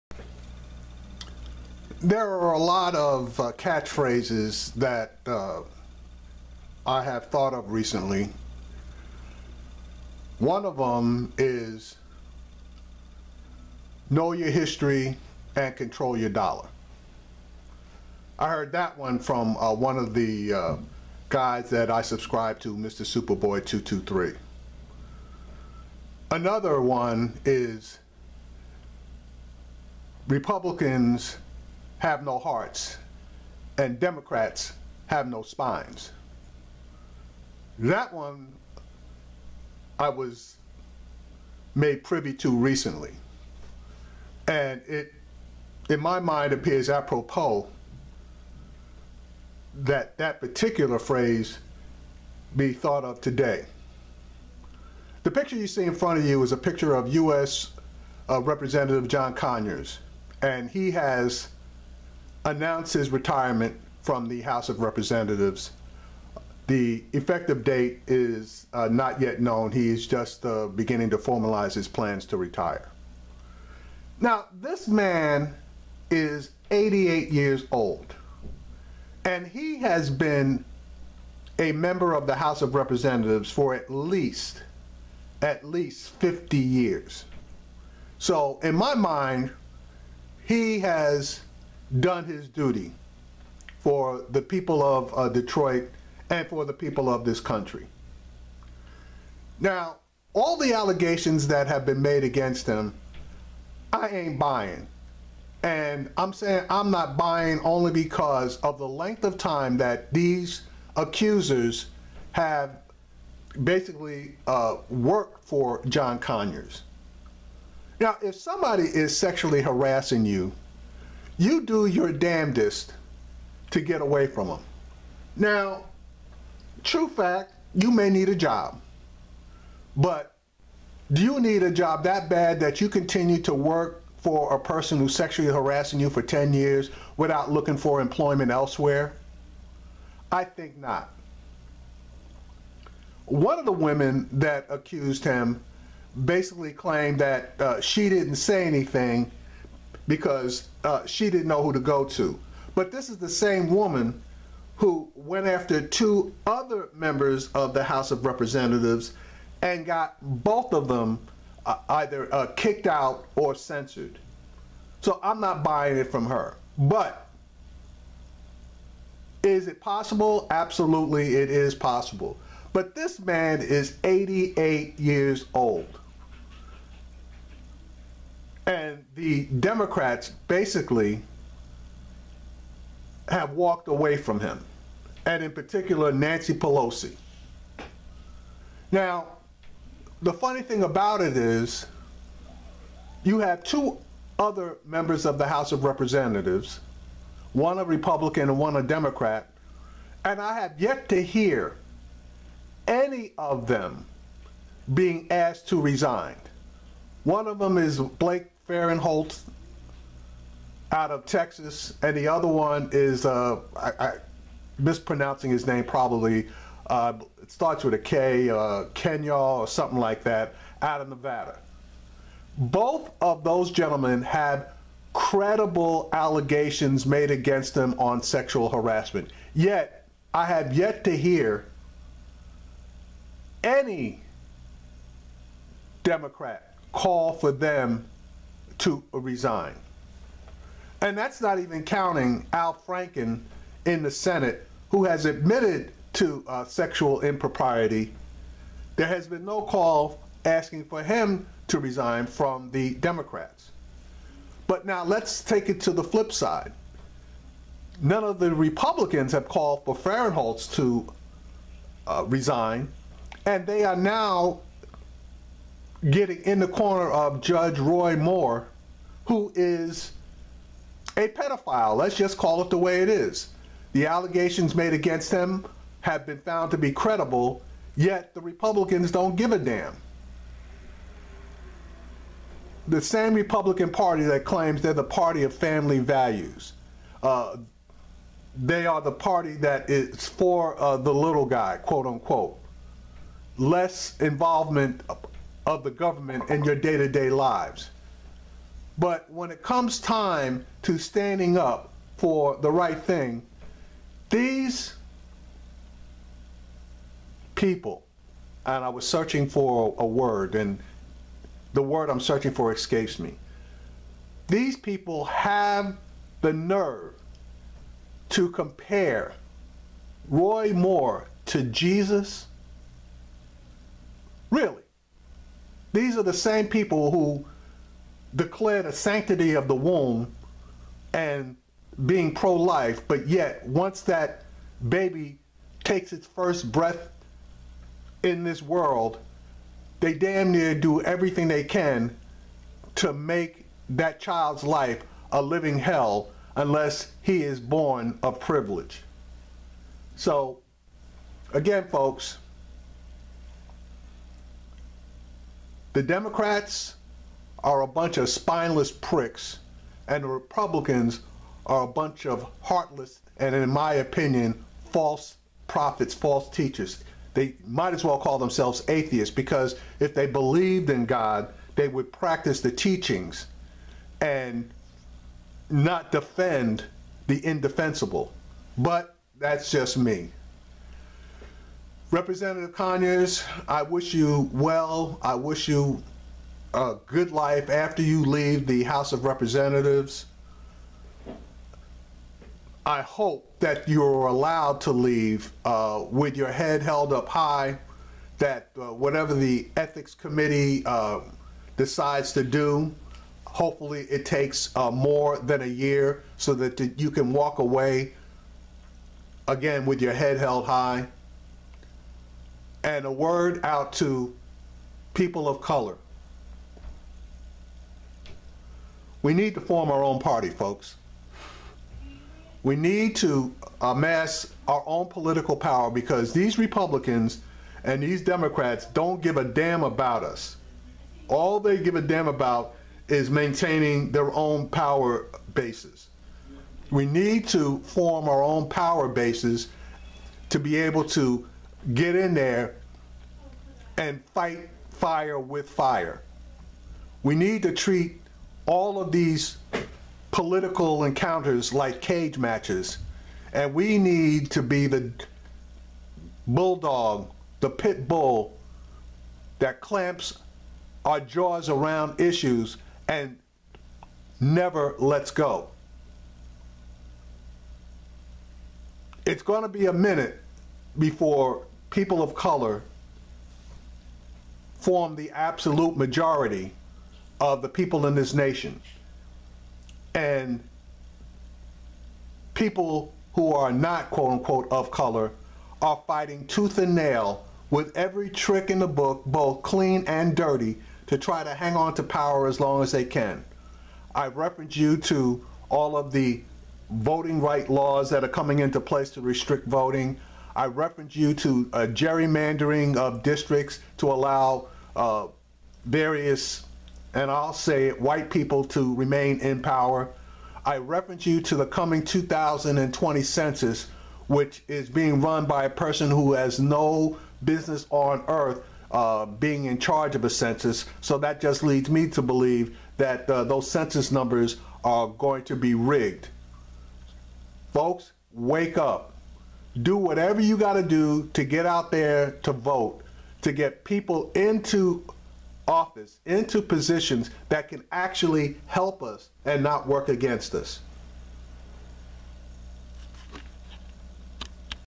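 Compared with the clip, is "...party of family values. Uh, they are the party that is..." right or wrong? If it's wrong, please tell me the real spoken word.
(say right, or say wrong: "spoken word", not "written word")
right.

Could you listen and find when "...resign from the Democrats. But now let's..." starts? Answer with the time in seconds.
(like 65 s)
251 s.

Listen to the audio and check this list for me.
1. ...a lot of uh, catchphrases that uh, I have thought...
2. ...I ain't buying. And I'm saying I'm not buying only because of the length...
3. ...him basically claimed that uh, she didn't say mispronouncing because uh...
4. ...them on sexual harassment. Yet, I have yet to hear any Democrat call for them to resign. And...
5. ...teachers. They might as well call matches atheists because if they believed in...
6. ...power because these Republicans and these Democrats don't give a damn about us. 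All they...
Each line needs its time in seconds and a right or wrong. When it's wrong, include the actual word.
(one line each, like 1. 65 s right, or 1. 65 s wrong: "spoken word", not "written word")
1. 2 s right
2. 103 s right
3. 145 s wrong: "anything", not "mispronouncing"
4. 227 s right
5. 366 s wrong: "themselves", not "matches"
6. 425 s right.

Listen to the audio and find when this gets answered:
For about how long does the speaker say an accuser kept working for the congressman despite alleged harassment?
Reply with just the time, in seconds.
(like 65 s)
136 s.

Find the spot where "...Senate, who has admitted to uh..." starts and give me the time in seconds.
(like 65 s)
244 s.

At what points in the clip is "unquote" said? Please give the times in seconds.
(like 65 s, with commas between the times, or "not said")
292 s, 484 s.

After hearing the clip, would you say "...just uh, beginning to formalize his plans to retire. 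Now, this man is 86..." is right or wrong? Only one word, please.
wrong.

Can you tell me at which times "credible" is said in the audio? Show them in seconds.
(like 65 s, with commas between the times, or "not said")
225 s, 276 s.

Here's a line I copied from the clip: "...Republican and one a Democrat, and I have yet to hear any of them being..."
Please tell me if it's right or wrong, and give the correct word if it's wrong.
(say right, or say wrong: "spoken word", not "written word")
right.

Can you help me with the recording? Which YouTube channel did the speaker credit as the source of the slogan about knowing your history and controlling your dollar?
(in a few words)
Mr. Superboy 223.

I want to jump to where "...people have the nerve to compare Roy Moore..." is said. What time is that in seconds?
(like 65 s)
314 s.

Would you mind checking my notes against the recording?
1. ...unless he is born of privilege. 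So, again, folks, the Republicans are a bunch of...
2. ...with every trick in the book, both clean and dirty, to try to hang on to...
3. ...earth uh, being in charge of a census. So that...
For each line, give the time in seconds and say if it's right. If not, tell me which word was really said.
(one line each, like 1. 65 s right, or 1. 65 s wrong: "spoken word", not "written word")
1. 346 s wrong: "Democrats", not "Republicans"
2. 487 s right
3. 518 s right.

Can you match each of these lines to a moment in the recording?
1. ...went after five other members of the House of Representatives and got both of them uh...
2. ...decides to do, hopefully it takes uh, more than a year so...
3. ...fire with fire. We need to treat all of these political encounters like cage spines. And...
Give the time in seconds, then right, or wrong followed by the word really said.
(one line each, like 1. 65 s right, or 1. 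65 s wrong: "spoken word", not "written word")
1. 155 s wrong: "two", not "five"
2. 401 s right
3. 444 s wrong: "matches", not "spines".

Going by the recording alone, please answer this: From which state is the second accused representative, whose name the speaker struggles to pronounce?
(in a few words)
Nevada.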